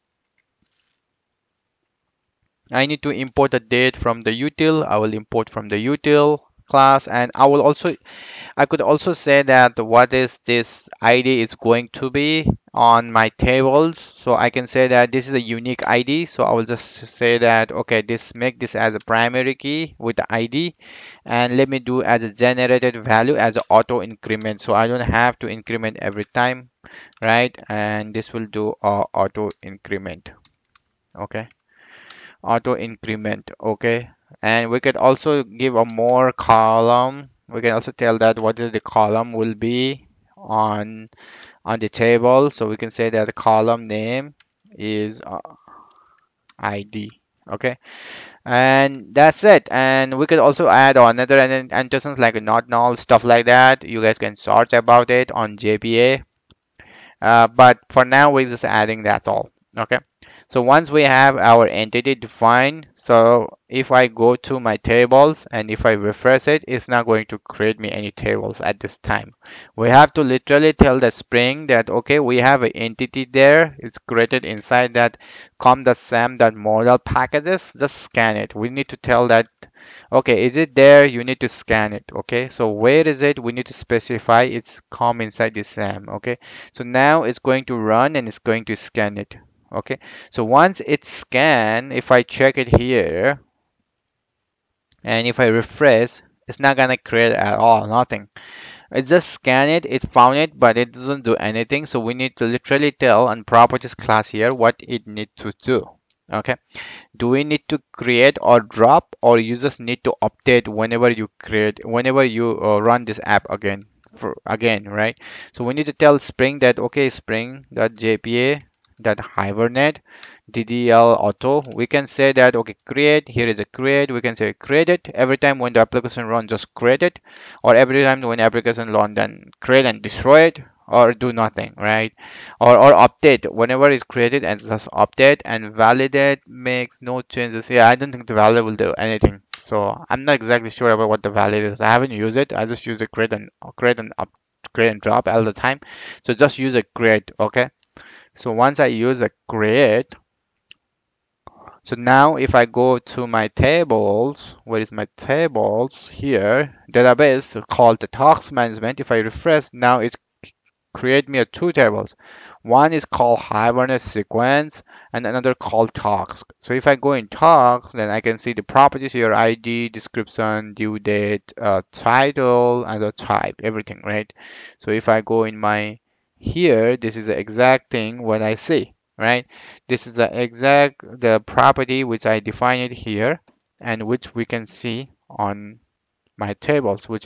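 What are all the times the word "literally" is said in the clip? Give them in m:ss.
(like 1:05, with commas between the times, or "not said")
1:10, 1:42.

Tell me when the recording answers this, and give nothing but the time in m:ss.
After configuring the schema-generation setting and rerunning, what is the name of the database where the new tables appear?
2:38.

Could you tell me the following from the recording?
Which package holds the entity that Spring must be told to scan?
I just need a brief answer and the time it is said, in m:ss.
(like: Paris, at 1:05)
com.sam.model, at 1:15.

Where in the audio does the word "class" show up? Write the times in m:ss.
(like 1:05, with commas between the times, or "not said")
0:06, 1:43.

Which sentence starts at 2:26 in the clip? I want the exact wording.
So just use a create, okay?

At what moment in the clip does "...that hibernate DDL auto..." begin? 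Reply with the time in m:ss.
1:58.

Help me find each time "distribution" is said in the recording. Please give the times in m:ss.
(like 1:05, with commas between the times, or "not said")
not said.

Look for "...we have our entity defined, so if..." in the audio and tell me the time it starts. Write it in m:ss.
1:00.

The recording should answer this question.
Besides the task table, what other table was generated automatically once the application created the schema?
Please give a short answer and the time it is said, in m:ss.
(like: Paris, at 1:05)
Hibernate sequence, at 2:43.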